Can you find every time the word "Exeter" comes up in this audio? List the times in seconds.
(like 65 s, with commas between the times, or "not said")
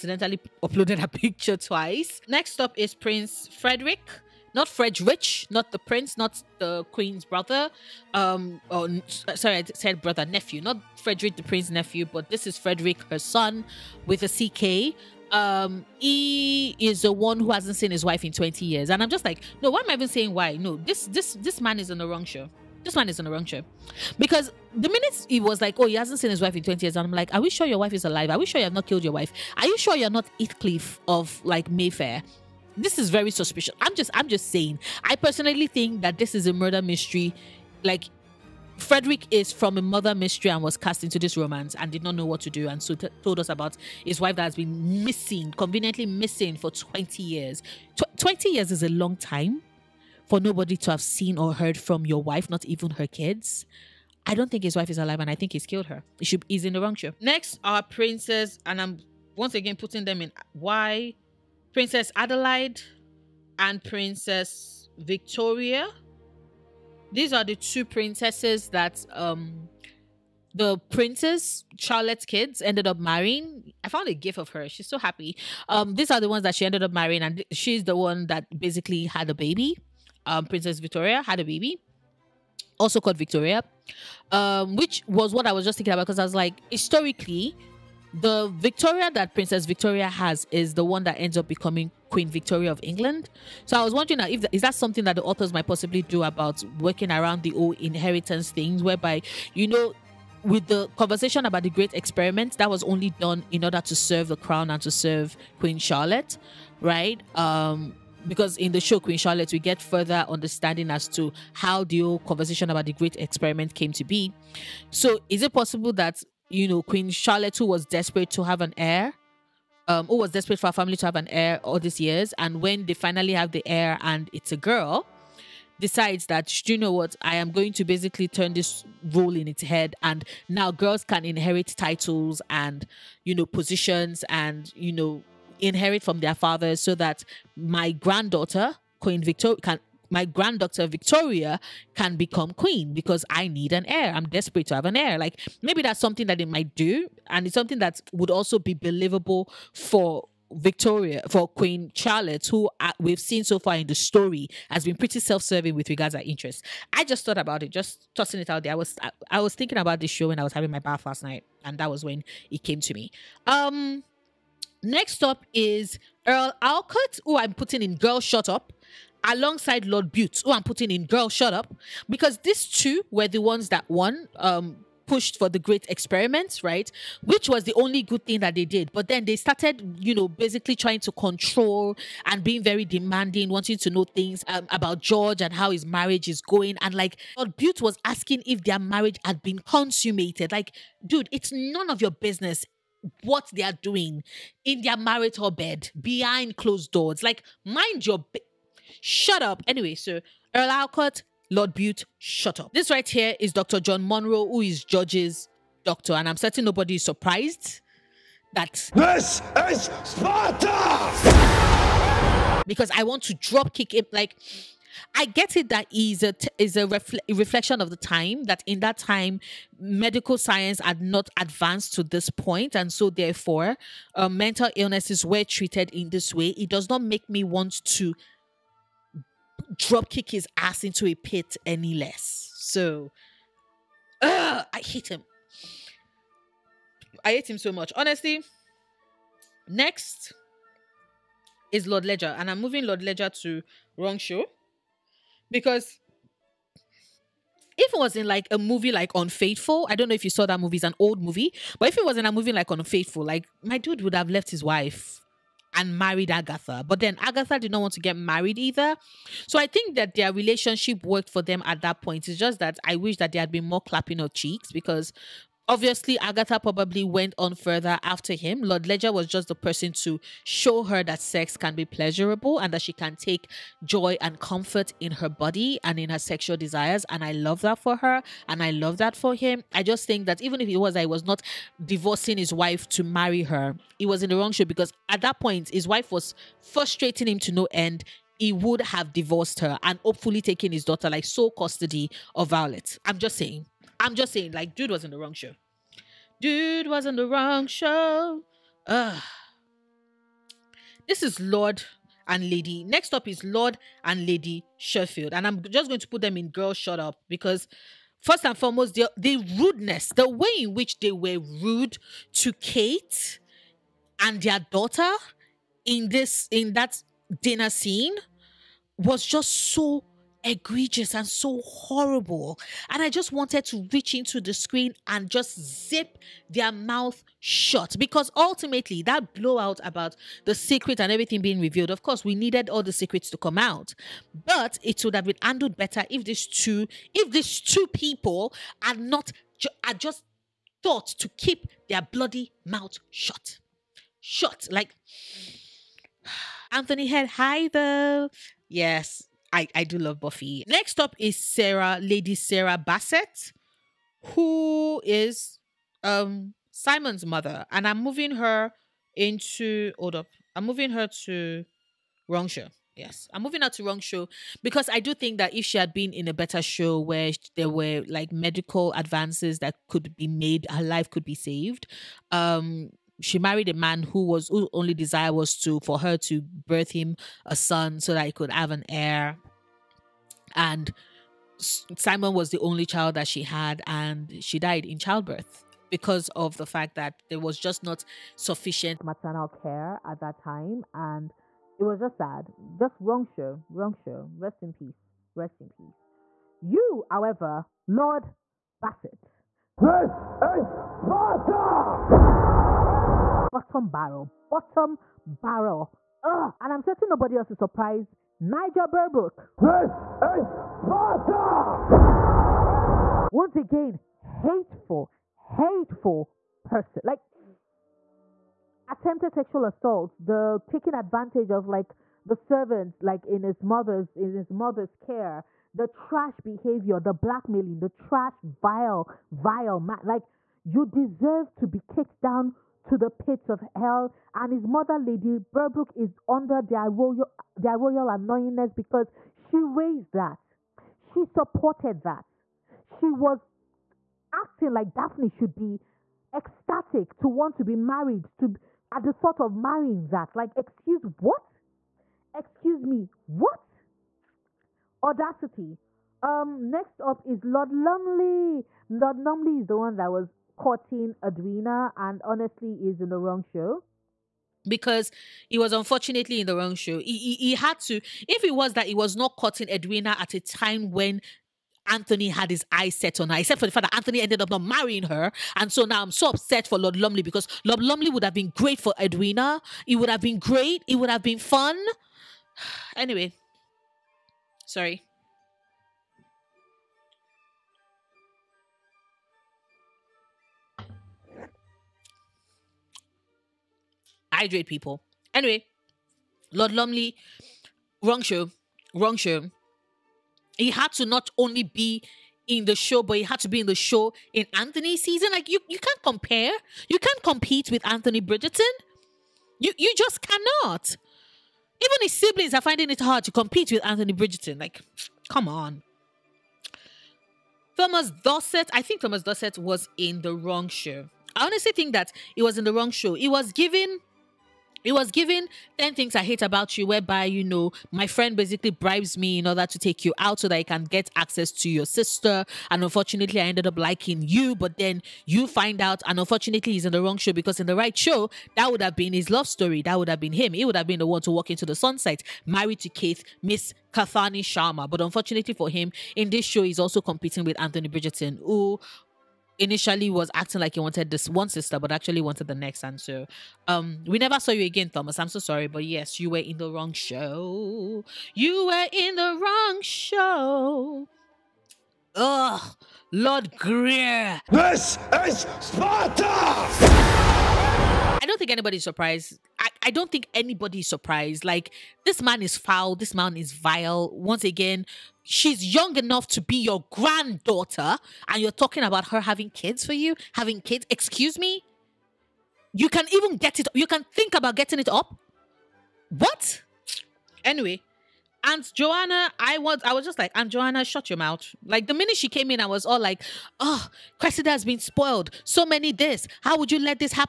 not said.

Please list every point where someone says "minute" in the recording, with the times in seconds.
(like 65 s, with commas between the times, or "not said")
24 s, 591 s.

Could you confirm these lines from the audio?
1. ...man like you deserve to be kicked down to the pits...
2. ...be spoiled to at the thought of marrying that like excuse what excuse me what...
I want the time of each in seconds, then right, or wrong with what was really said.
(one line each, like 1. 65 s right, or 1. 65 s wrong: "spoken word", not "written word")
1. 429 s right
2. 447 s wrong: "married", not "spoiled".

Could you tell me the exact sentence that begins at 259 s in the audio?
So I think that their relationship worked for them at that point.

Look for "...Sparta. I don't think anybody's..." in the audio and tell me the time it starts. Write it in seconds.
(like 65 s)
565 s.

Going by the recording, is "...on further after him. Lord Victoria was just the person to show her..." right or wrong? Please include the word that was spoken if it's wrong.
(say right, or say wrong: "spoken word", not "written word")
wrong: "Ledger", not "Victoria".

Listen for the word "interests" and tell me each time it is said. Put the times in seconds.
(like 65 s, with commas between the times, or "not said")
156 s.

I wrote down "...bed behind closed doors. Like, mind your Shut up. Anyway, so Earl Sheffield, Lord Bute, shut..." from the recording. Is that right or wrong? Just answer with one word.
wrong.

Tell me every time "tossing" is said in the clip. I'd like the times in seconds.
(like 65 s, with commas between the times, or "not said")
158 s.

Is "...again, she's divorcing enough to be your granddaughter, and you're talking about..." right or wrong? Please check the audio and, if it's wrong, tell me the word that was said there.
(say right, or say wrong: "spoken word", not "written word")
wrong: "young", not "divorcing".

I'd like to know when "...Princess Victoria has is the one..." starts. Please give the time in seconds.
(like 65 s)
89 s.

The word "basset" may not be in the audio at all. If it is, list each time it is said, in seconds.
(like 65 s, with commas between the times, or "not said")
352 s, 398 s.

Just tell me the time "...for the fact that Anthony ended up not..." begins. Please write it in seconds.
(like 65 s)
473 s.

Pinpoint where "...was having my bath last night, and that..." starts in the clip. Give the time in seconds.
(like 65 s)
160 s.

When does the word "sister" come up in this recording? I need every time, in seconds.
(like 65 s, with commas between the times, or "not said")
531 s, 551 s.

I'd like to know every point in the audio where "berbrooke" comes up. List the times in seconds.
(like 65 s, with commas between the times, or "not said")
408 s, 435 s.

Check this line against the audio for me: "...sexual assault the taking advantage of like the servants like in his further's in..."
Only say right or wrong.
wrong.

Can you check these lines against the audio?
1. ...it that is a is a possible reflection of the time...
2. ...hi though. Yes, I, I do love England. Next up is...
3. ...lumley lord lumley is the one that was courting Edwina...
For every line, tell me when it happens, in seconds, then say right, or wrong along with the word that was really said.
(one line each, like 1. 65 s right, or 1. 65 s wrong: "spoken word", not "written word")
1. 215 s wrong: "refle", not "possible"
2. 347 s wrong: "Buffy", not "England"
3. 457 s right.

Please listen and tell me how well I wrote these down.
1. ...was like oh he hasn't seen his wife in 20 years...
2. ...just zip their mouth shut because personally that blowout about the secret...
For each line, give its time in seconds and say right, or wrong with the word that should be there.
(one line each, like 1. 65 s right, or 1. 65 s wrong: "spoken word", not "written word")
1. 25 s right
2. 325 s wrong: "ultimately", not "personally".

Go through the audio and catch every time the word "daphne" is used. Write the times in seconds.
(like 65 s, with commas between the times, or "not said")
444 s.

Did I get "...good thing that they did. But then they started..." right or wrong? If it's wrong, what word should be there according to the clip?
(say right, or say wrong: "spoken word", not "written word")
right.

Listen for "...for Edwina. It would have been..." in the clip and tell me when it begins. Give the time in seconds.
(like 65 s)
478 s.